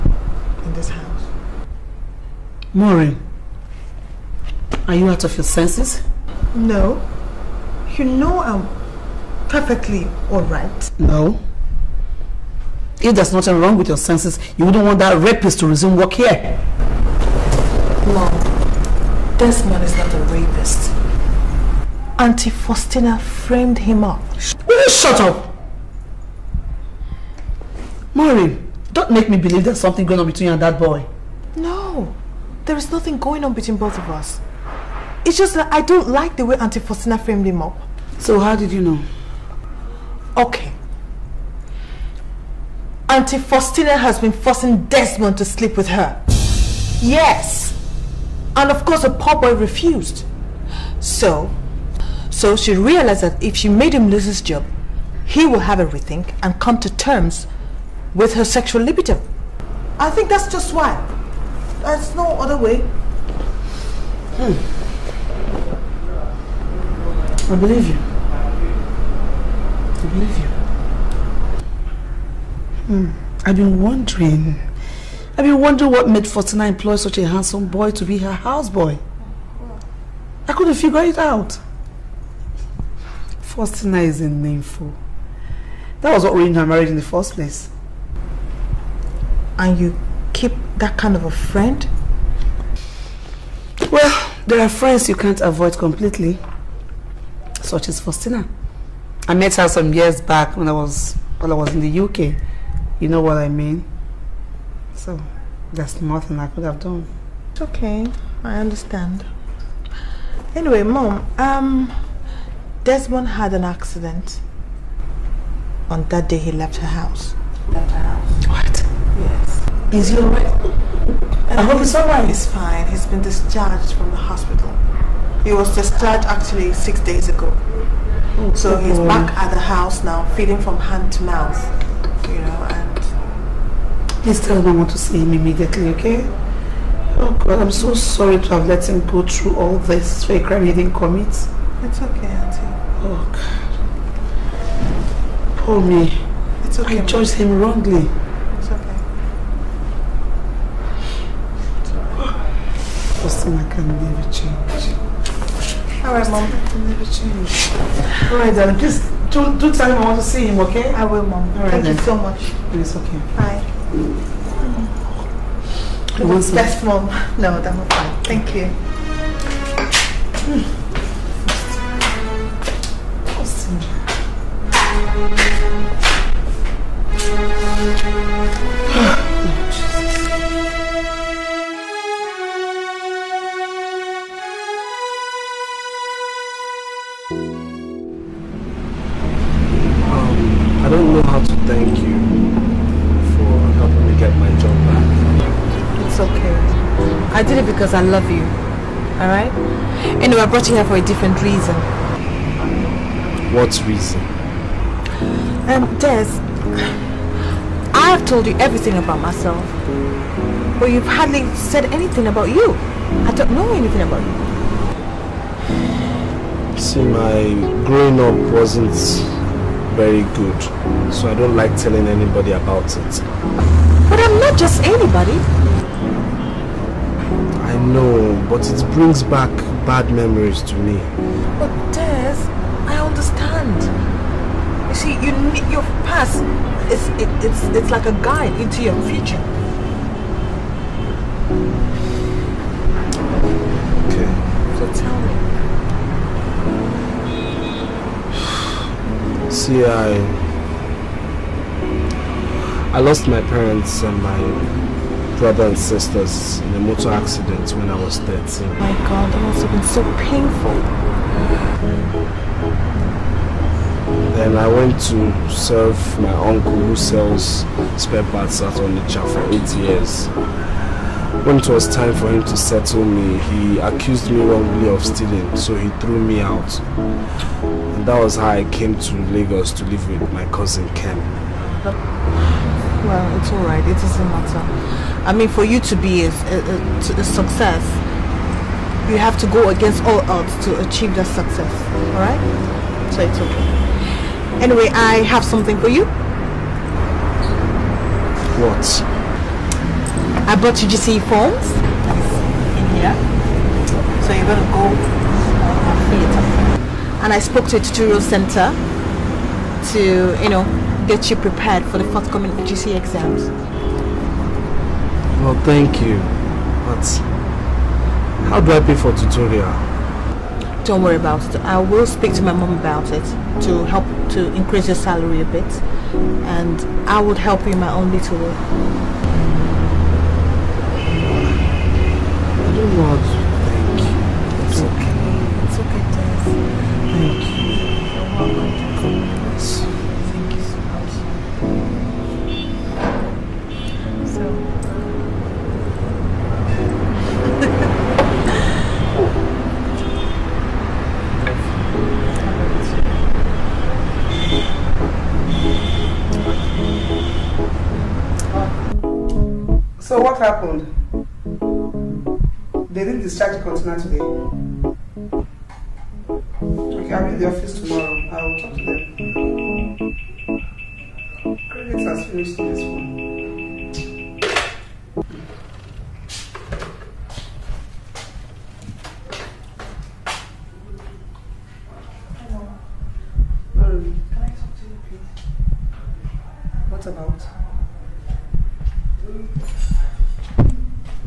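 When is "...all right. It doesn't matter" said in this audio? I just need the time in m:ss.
4:43.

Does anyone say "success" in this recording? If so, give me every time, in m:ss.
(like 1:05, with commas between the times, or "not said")
4:47, 4:51.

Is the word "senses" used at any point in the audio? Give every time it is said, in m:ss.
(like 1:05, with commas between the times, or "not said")
0:05, 0:13.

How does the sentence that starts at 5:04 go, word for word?
So you're going to go on theater.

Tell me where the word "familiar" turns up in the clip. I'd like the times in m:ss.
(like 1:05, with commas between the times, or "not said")
not said.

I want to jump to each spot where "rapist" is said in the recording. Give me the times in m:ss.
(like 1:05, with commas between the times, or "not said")
0:15, 0:20.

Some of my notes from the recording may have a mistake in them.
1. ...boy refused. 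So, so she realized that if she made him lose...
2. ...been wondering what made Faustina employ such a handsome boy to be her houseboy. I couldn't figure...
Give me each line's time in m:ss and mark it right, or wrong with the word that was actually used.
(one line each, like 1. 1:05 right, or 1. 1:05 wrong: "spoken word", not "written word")
1. 0:49 right
2. 1:15 right.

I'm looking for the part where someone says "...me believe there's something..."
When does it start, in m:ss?
0:29.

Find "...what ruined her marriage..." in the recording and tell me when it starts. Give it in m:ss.
1:26.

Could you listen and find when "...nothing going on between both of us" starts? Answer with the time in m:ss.
0:32.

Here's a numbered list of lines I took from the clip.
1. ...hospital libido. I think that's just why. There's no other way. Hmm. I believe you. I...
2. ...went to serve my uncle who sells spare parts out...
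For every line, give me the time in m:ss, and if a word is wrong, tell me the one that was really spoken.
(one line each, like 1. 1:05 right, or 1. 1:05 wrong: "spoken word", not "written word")
1. 0:58 wrong: "sexual", not "hospital"
2. 4:24 right.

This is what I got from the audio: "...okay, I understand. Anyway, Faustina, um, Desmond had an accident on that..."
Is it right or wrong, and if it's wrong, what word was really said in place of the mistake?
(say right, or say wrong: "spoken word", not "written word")
wrong: "Mom", not "Faustina".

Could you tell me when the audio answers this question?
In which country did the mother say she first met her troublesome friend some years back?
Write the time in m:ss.
1:41.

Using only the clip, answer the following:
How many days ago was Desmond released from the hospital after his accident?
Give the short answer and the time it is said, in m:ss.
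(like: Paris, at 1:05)
6, at 2:06.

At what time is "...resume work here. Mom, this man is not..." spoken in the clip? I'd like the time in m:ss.
0:15.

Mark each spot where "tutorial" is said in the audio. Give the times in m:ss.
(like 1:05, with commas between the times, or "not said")
5:07, 5:19.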